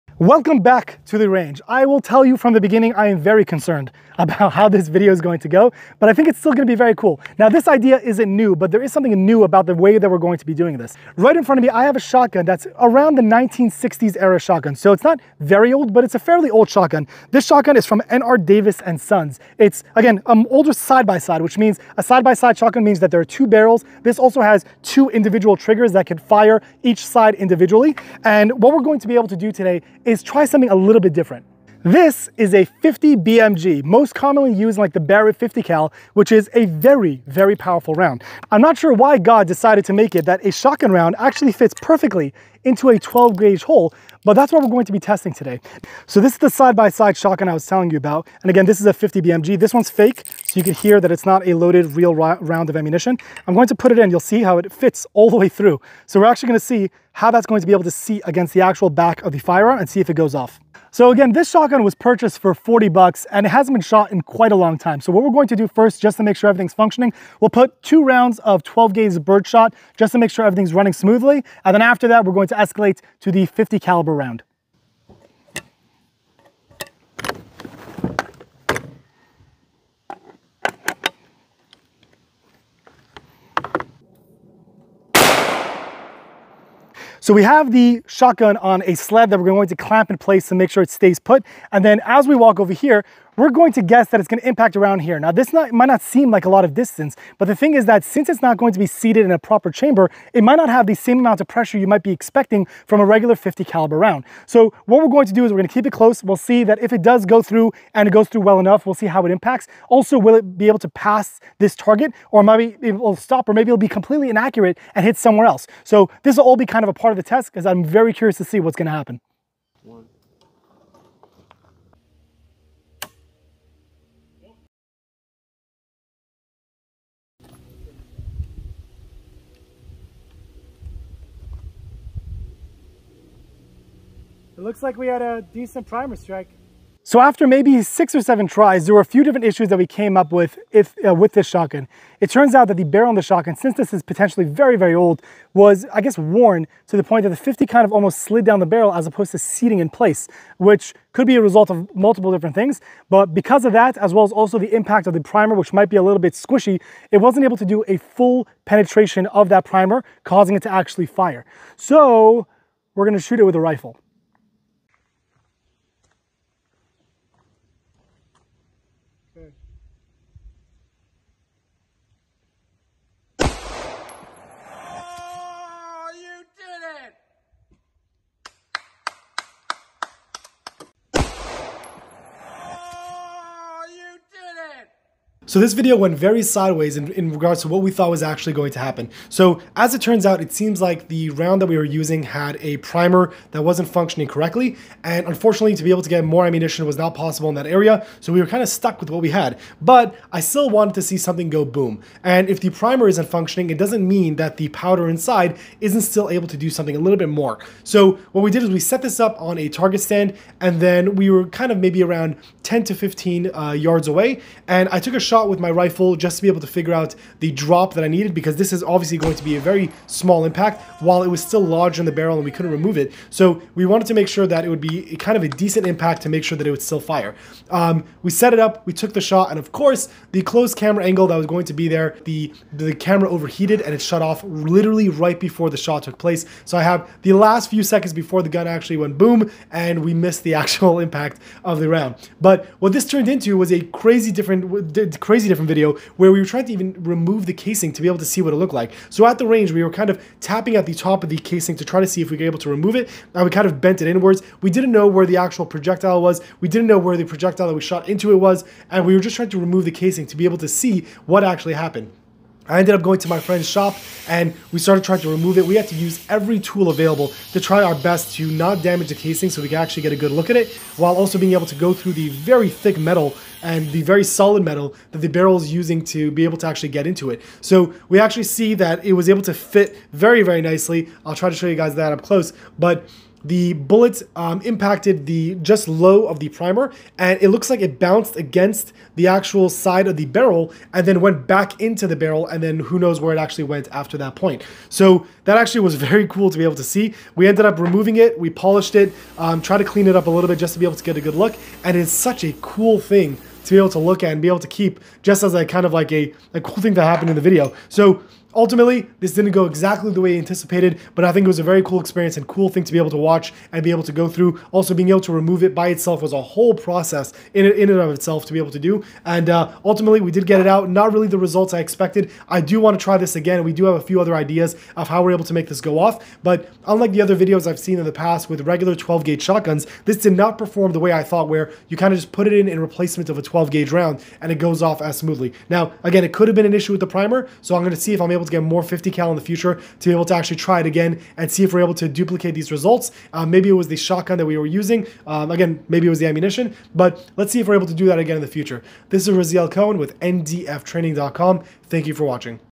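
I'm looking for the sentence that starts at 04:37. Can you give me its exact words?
So we actually see that it was able to fit very, very nicely.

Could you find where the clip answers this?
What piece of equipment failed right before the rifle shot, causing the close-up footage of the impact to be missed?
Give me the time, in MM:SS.
03:52.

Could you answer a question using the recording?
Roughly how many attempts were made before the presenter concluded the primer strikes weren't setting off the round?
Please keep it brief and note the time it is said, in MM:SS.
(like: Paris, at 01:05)
6 or 7, at 02:17.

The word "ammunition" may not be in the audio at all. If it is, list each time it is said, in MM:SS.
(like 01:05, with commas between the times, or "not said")
00:52, 03:16, 05:46.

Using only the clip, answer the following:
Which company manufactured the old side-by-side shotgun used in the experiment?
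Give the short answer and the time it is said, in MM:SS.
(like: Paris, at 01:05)
N.R. Davis and Sons, at 00:18.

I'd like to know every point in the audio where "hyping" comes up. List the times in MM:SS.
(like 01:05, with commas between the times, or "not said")
not said.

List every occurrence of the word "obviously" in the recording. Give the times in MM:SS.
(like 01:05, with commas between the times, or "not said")
03:38.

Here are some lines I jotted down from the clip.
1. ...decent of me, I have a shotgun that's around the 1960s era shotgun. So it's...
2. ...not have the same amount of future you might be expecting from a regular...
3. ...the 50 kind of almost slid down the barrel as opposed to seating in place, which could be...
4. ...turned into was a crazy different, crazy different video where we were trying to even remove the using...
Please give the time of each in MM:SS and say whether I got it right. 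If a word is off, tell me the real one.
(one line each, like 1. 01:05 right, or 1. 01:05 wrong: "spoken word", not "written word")
1. 00:11 wrong: "front", not "decent"
2. 01:40 wrong: "pressure", not "future"
3. 02:27 right
4. 04:03 wrong: "casing", not "using".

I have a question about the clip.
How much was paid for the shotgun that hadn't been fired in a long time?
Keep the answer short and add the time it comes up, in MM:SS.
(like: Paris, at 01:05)
$40, at 01:02.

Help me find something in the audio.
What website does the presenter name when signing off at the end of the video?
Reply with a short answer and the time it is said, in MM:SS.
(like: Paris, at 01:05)
ndftraining.com, at 05:50.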